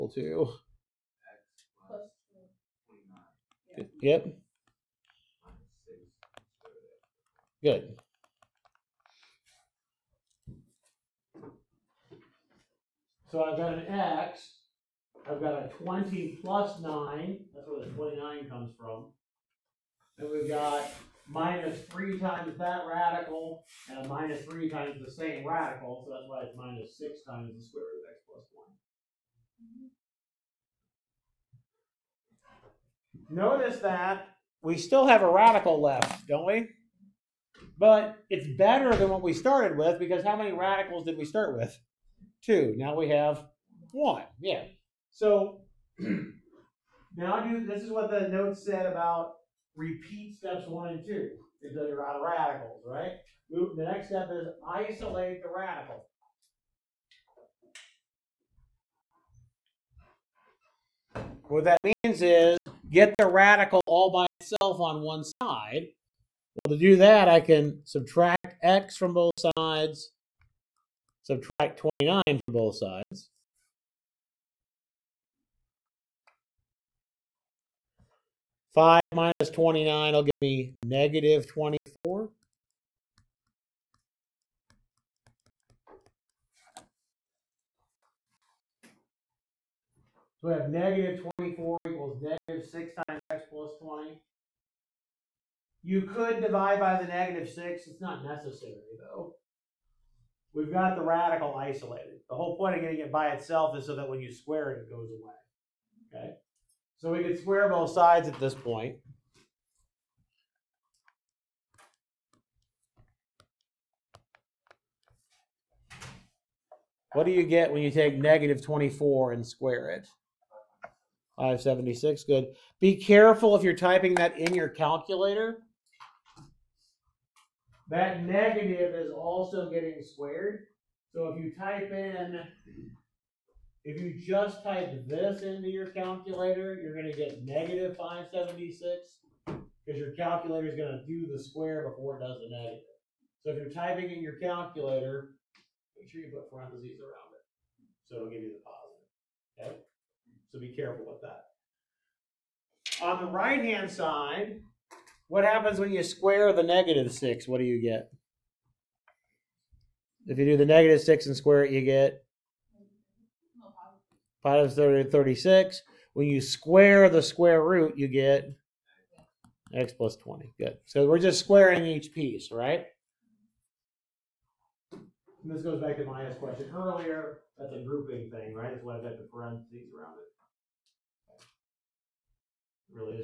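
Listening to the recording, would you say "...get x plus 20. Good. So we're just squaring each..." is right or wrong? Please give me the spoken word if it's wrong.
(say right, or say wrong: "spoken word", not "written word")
right.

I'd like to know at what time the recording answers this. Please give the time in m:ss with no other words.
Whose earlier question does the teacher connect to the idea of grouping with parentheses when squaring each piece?
2:56.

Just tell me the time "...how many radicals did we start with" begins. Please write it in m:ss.
0:40.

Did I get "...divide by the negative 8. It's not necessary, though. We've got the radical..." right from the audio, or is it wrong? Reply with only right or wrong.
wrong.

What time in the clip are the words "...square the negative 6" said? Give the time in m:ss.
2:36.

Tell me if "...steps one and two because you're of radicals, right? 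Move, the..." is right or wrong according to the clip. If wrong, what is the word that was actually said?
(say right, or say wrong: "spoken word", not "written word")
right.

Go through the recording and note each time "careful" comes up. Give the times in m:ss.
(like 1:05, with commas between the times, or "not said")
2:02, 2:30.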